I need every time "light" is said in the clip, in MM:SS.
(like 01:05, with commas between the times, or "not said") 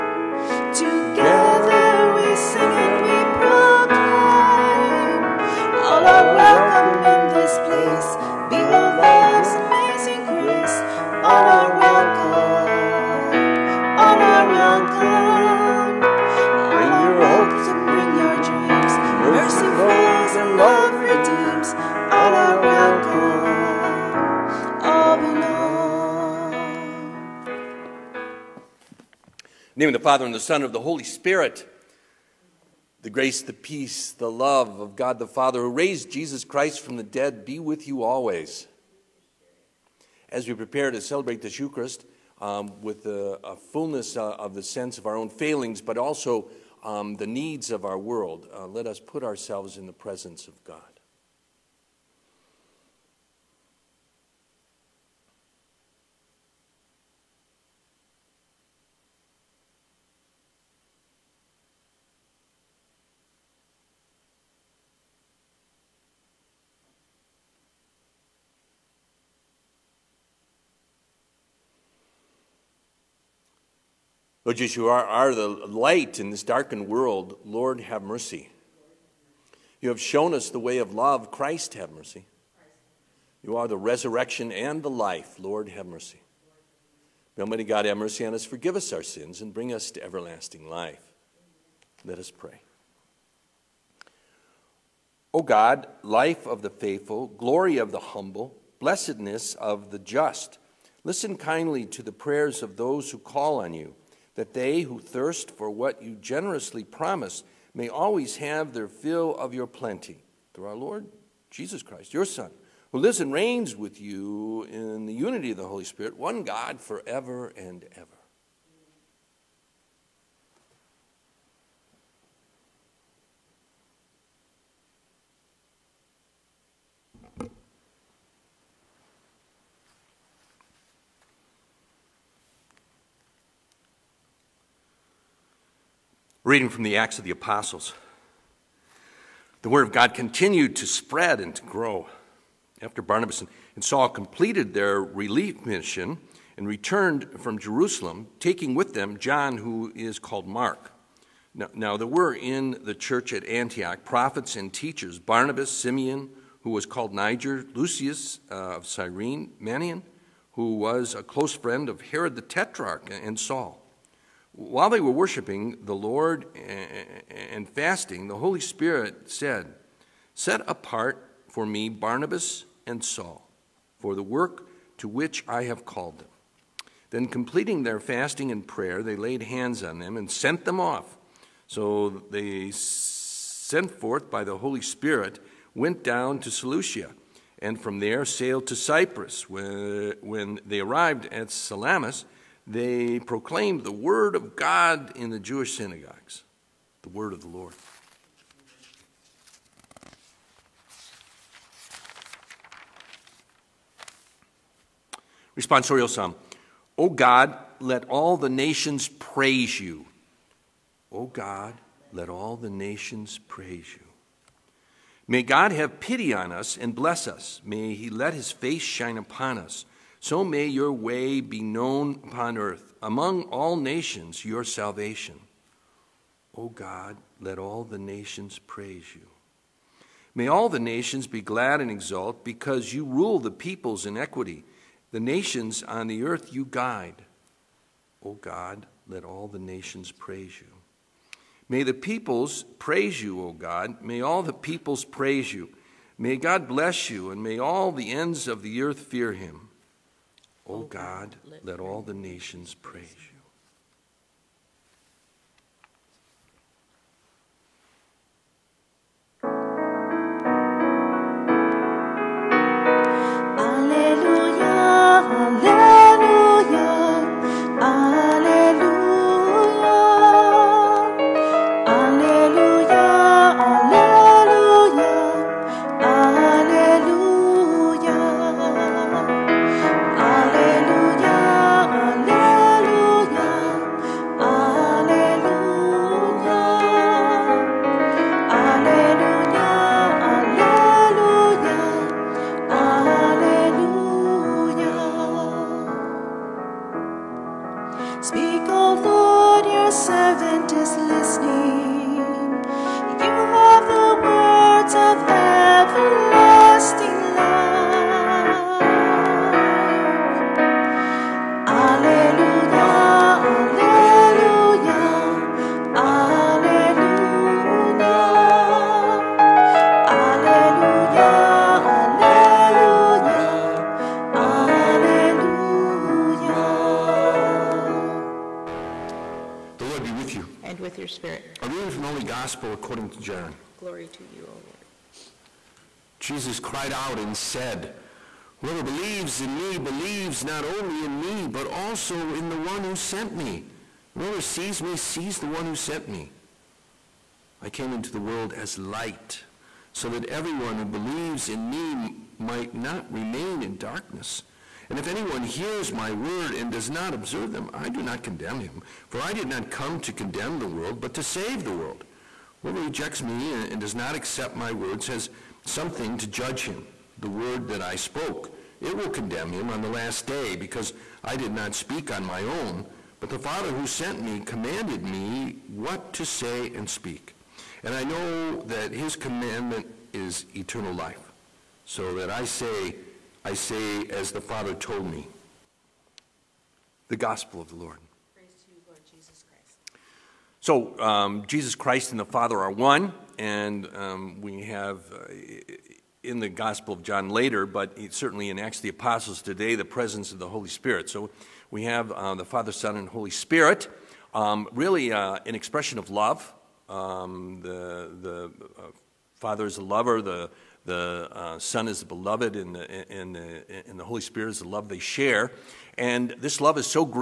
01:15, 05:48.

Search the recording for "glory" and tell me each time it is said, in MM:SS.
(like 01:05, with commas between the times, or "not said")
01:37, 05:33.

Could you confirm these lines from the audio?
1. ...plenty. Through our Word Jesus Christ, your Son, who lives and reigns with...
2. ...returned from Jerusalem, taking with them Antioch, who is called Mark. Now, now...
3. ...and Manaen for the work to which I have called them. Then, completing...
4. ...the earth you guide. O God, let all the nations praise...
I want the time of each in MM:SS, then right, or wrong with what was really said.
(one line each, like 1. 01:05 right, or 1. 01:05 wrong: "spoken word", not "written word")
1. 01:49 wrong: "Lord", not "Word"
2. 02:26 wrong: "John", not "Antioch"
3. 02:52 wrong: "Saul", not "Manaen"
4. 03:56 right.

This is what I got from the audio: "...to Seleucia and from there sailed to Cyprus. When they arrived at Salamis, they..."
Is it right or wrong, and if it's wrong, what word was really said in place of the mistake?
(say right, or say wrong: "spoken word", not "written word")
right.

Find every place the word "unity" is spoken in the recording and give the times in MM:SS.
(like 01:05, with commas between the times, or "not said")
01:55.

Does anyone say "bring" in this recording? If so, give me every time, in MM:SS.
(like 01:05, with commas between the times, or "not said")
01:29.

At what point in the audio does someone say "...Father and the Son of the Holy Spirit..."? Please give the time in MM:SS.
00:30.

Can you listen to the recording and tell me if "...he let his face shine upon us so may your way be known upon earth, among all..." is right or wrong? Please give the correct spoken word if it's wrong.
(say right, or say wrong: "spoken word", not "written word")
right.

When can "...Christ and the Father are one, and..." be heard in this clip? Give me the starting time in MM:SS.
06:31.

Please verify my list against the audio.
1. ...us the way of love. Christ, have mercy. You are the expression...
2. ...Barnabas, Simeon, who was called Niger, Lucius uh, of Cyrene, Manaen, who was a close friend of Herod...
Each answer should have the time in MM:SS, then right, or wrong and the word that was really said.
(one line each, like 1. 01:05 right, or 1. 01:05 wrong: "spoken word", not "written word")
1. 01:20 wrong: "resurrection", not "expression"
2. 02:35 right.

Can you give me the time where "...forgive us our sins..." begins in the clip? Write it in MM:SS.
01:28.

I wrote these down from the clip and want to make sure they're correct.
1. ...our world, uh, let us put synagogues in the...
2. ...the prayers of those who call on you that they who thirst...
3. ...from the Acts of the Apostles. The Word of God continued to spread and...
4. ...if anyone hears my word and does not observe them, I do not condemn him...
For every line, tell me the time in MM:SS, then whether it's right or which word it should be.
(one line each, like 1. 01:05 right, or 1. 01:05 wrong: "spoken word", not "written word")
1. 00:47 wrong: "ourselves", not "synagogues"
2. 01:42 right
3. 02:16 right
4. 05:54 right.